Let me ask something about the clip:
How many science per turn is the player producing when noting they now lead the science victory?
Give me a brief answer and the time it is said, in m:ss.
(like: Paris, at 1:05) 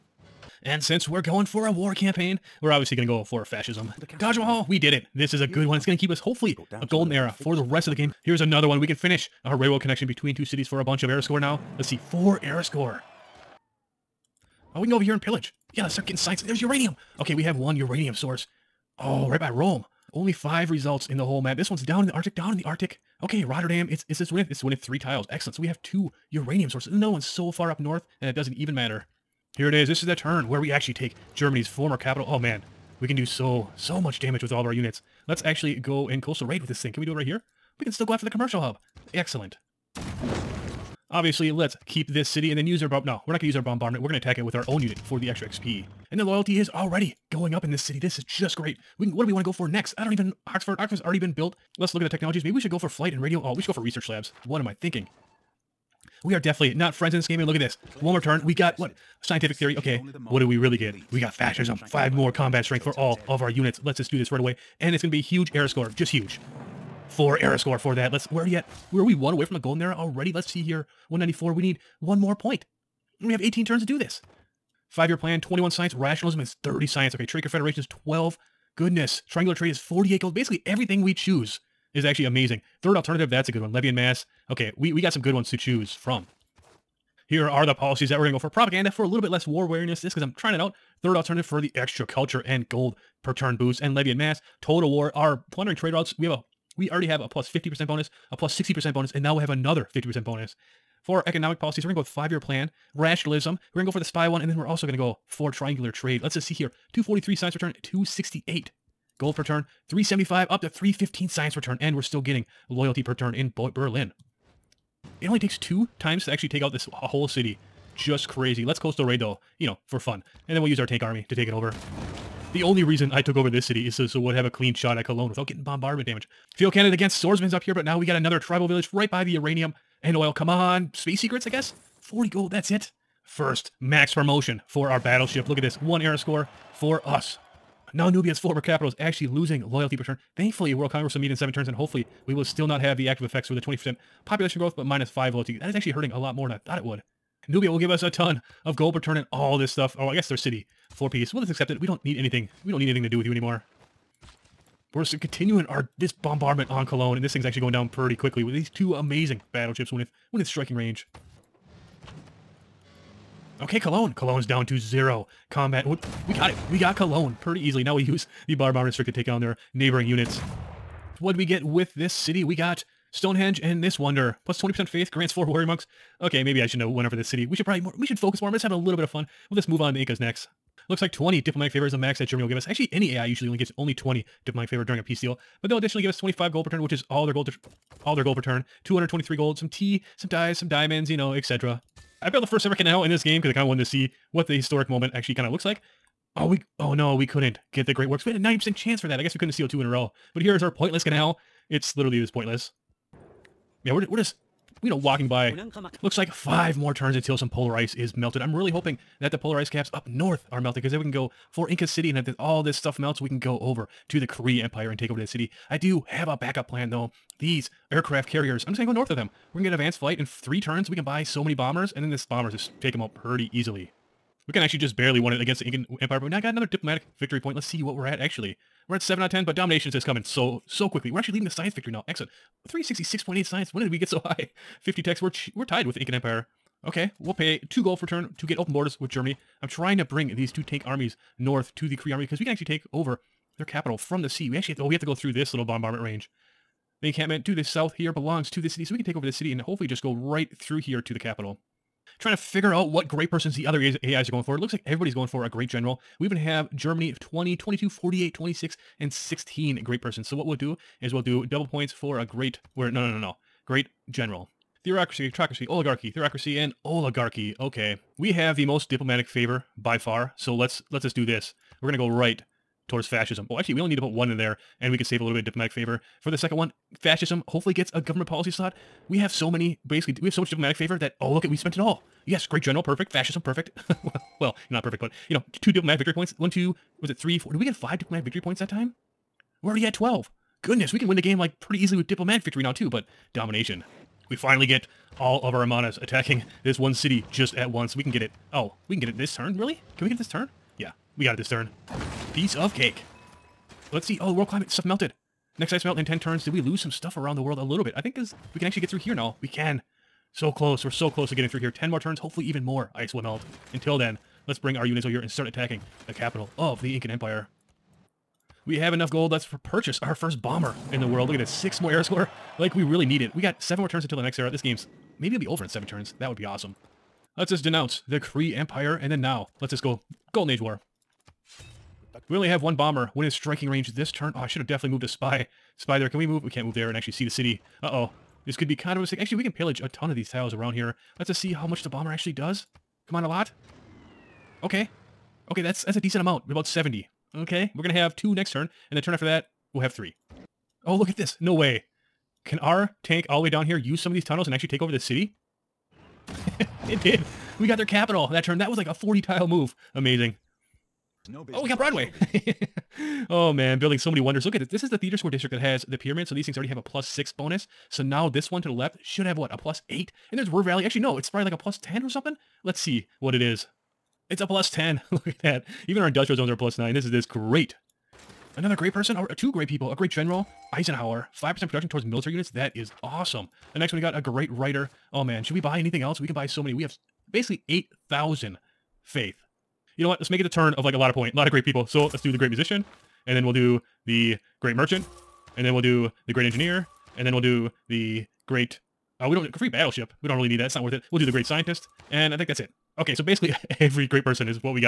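366.8, at 3:52.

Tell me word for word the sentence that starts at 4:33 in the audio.
Well, oh, actually, we only need to put one in there, and we could save a little bit of diplomatic favor.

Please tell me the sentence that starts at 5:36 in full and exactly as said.
We can't move there and actually see the city.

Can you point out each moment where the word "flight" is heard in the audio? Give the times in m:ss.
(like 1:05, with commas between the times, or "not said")
0:52, 3:39.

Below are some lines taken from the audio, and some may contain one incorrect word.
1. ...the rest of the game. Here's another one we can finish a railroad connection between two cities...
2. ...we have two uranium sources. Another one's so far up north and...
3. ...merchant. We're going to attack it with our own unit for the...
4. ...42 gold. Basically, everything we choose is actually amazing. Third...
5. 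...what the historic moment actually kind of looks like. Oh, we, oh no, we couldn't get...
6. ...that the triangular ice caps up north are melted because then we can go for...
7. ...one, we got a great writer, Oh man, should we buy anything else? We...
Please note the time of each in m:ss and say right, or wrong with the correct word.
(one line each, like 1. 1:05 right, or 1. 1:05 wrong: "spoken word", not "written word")
1. 0:07 right
2. 0:25 right
3. 0:43 wrong: "bombardment", not "merchant"
4. 1:19 wrong: "48", not "42"
5. 3:14 right
6. 3:29 wrong: "polar", not "triangular"
7. 6:23 right.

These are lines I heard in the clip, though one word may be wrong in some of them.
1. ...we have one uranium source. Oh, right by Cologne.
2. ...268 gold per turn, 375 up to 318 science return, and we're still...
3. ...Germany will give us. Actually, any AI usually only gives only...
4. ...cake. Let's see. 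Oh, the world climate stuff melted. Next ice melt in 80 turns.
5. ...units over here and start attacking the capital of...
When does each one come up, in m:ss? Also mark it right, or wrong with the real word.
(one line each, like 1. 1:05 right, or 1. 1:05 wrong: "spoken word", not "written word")
1. 0:17 wrong: "Rome", not "Cologne"
2. 1:47 wrong: "315", not "318"
3. 3:02 right
4. 5:02 wrong: "10", not "80"
5. 5:14 right.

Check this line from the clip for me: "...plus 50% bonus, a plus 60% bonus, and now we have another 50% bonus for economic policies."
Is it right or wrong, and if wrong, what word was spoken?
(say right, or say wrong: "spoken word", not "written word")
right.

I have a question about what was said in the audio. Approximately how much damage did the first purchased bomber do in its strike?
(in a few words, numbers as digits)
About 70.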